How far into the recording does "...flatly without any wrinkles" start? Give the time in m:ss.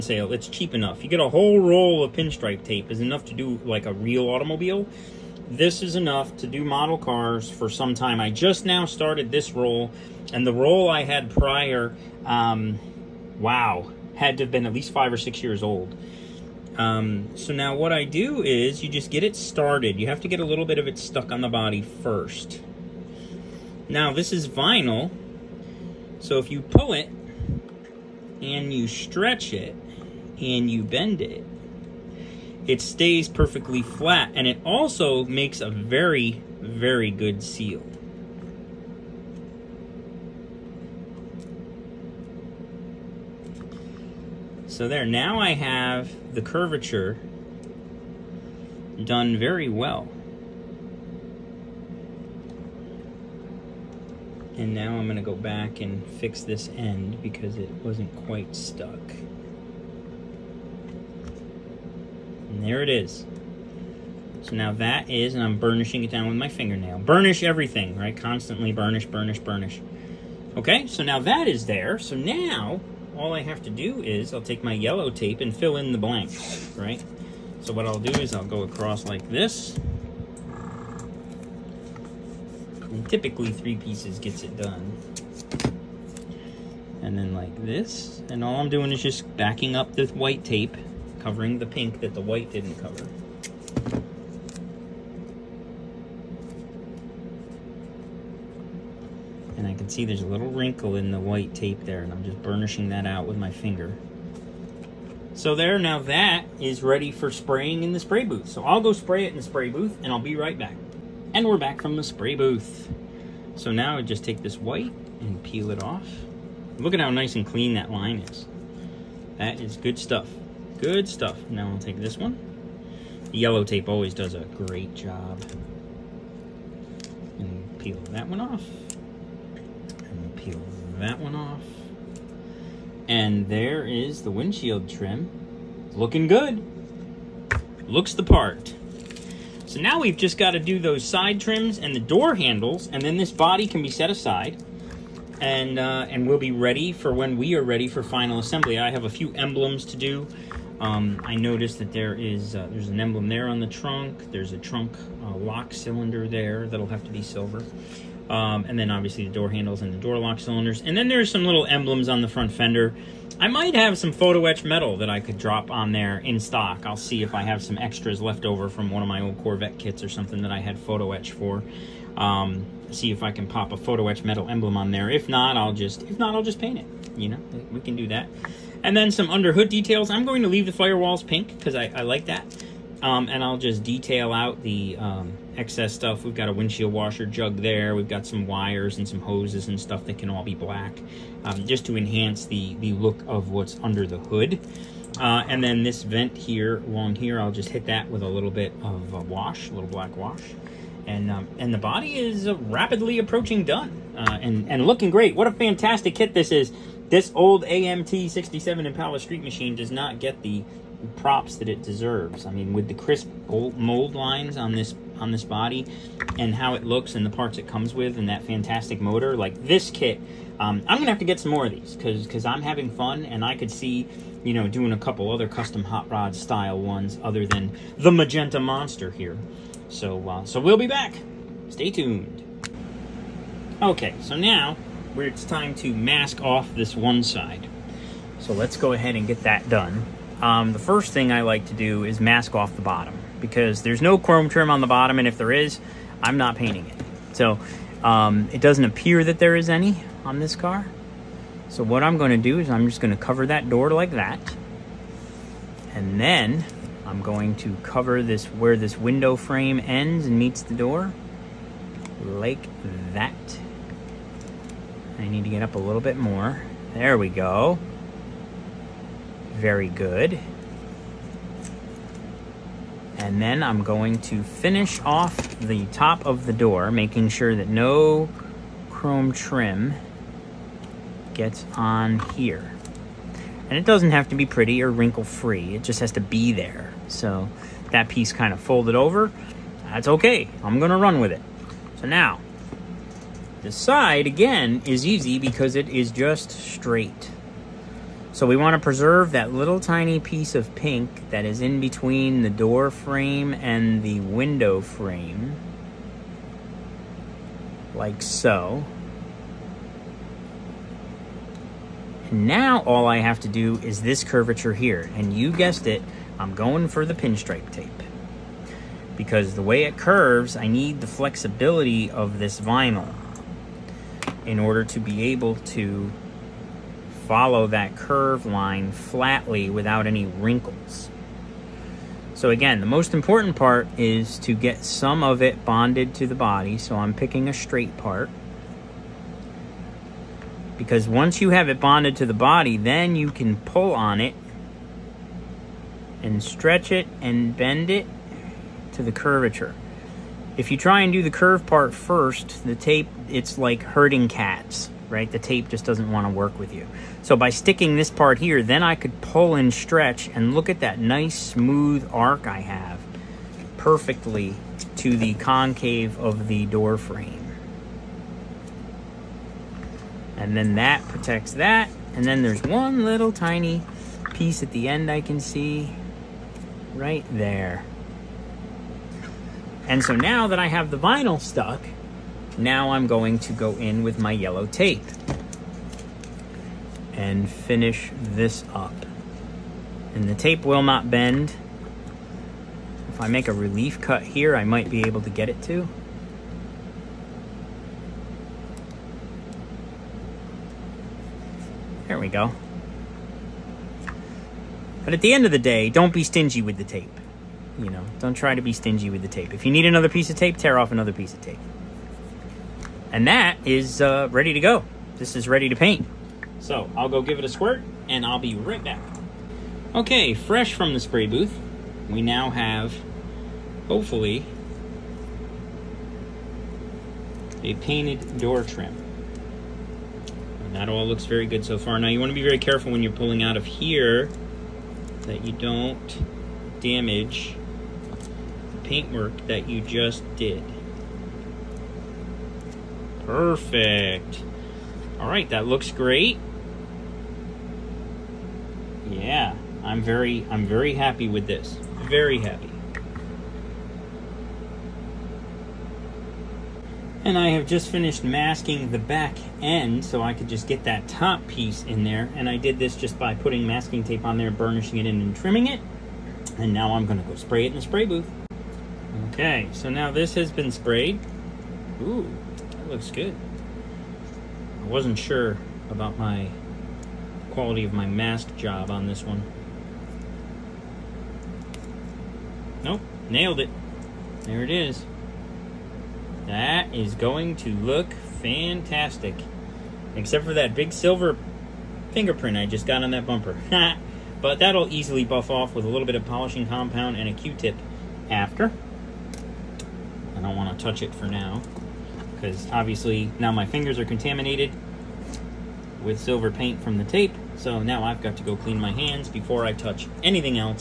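5:28.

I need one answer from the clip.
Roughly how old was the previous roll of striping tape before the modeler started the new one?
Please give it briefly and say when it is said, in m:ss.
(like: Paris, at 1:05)
5 or 6 years, at 0:14.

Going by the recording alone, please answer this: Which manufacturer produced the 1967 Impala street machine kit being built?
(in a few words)
AMT.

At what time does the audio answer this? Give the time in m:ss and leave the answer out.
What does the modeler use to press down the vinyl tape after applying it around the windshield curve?
1:06.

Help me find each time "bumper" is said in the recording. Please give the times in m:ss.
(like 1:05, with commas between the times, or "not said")
8:13.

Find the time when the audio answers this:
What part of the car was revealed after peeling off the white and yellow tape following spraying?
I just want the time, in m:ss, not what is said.
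2:14.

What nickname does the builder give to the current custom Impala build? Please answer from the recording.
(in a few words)
the magenta monster.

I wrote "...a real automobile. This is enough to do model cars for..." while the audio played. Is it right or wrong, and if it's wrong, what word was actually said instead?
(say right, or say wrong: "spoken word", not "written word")
right.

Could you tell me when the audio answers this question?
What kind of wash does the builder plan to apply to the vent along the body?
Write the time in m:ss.
3:19.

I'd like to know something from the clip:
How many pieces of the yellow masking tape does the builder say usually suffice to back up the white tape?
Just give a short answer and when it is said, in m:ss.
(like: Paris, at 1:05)
3, at 1:23.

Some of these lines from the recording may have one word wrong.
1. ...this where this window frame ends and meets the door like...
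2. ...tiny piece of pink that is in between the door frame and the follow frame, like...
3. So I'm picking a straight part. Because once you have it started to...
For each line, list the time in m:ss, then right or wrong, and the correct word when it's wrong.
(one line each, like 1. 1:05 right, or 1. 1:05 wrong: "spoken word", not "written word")
1. 4:18 right
2. 4:59 wrong: "window", not "follow"
3. 5:36 wrong: "bonded", not "started".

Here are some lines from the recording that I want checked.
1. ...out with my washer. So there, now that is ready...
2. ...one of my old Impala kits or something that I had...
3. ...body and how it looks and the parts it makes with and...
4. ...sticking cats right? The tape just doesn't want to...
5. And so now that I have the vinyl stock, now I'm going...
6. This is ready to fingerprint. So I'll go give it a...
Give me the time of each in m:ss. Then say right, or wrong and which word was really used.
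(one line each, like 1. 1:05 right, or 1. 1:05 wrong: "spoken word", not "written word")
1. 1:43 wrong: "finger", not "washer"
2. 2:48 wrong: "Corvette", not "Impala"
3. 3:35 wrong: "comes", not "makes"
4. 5:53 wrong: "herding", not "sticking"
5. 6:19 wrong: "stuck", not "stock"
6. 6:55 wrong: "paint", not "fingerprint".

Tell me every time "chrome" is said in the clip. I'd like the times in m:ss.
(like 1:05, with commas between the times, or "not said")
4:04, 4:38.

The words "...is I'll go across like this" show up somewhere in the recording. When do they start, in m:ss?
1:18.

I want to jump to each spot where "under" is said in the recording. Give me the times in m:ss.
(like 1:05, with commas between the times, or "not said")
2:59, 3:13.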